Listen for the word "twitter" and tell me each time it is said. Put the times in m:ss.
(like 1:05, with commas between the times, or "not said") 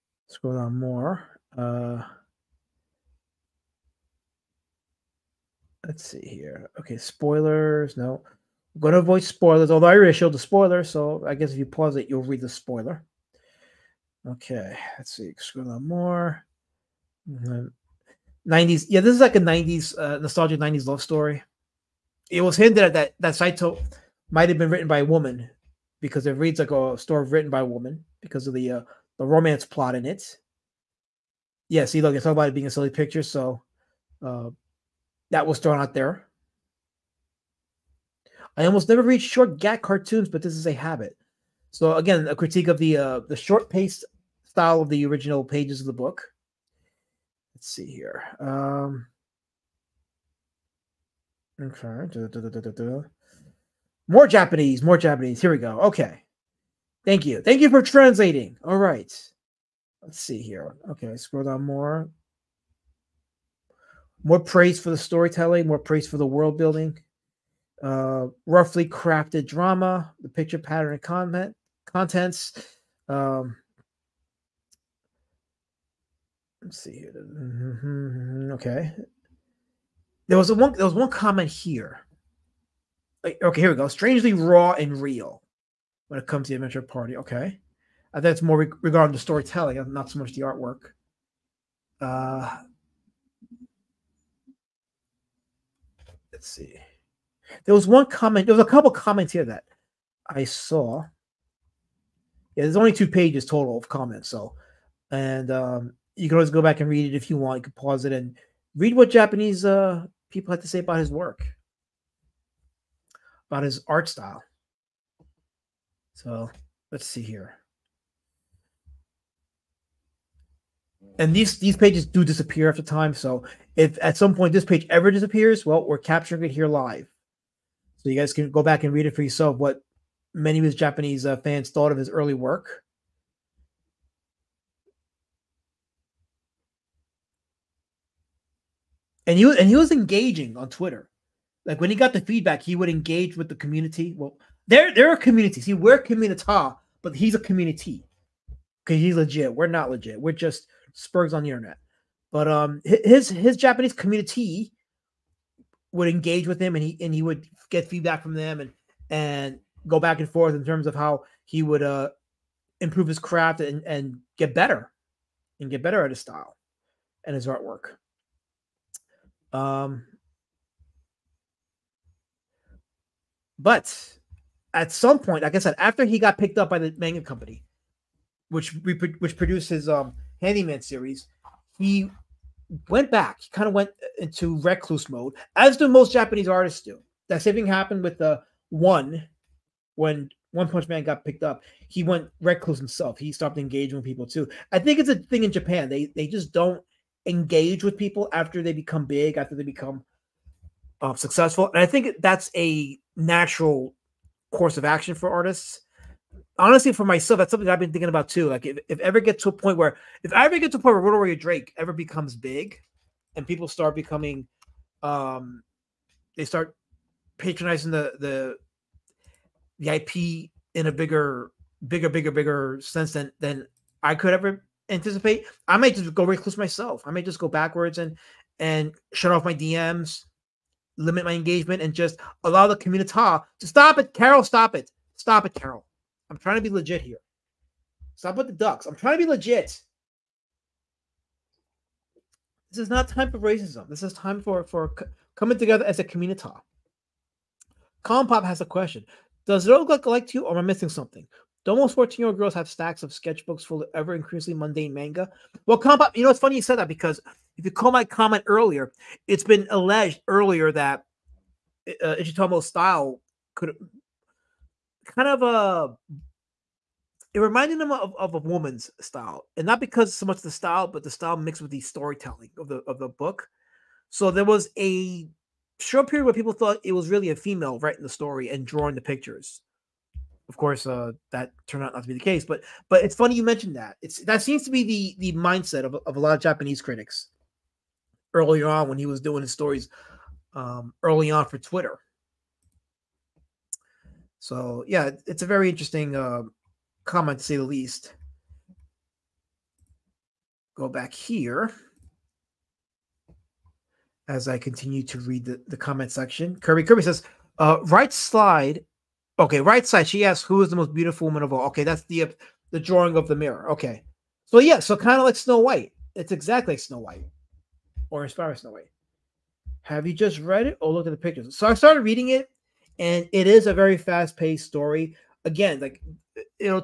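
2:20, 4:51.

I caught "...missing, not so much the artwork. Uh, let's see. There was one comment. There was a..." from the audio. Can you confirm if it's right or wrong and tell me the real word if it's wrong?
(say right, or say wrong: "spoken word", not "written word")
wrong: "storytelling", not "missing".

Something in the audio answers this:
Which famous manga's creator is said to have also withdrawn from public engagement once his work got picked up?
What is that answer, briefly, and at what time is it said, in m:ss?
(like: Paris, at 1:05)
One Punch Man, at 3:10.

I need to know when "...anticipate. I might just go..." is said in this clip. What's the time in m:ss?
3:44.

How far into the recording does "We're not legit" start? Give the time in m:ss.
2:29.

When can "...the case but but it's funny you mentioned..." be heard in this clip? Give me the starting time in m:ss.
4:42.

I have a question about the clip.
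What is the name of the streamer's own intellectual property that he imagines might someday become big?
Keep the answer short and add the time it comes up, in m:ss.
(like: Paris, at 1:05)
Road Warrior Drake, at 3:31.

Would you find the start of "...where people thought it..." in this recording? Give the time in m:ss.
4:36.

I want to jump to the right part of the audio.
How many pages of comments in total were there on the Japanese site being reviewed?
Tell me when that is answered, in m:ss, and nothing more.
1:42.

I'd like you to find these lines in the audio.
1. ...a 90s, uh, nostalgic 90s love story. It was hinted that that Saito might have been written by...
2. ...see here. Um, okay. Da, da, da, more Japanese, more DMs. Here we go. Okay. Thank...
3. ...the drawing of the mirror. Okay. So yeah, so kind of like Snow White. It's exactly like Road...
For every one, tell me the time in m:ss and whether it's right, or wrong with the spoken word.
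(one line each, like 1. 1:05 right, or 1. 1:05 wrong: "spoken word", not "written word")
1. 0:19 right
2. 0:47 wrong: "Japanese", not "DMs"
3. 5:12 wrong: "Snow", not "Road".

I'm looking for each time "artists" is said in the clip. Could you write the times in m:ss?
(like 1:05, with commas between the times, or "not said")
3:06, 3:25.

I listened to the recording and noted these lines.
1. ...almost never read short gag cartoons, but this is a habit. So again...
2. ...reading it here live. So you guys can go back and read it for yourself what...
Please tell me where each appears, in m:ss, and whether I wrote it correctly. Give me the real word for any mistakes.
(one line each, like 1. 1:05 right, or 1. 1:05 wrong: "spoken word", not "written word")
1. 0:38 right
2. 2:05 wrong: "capturing", not "reading".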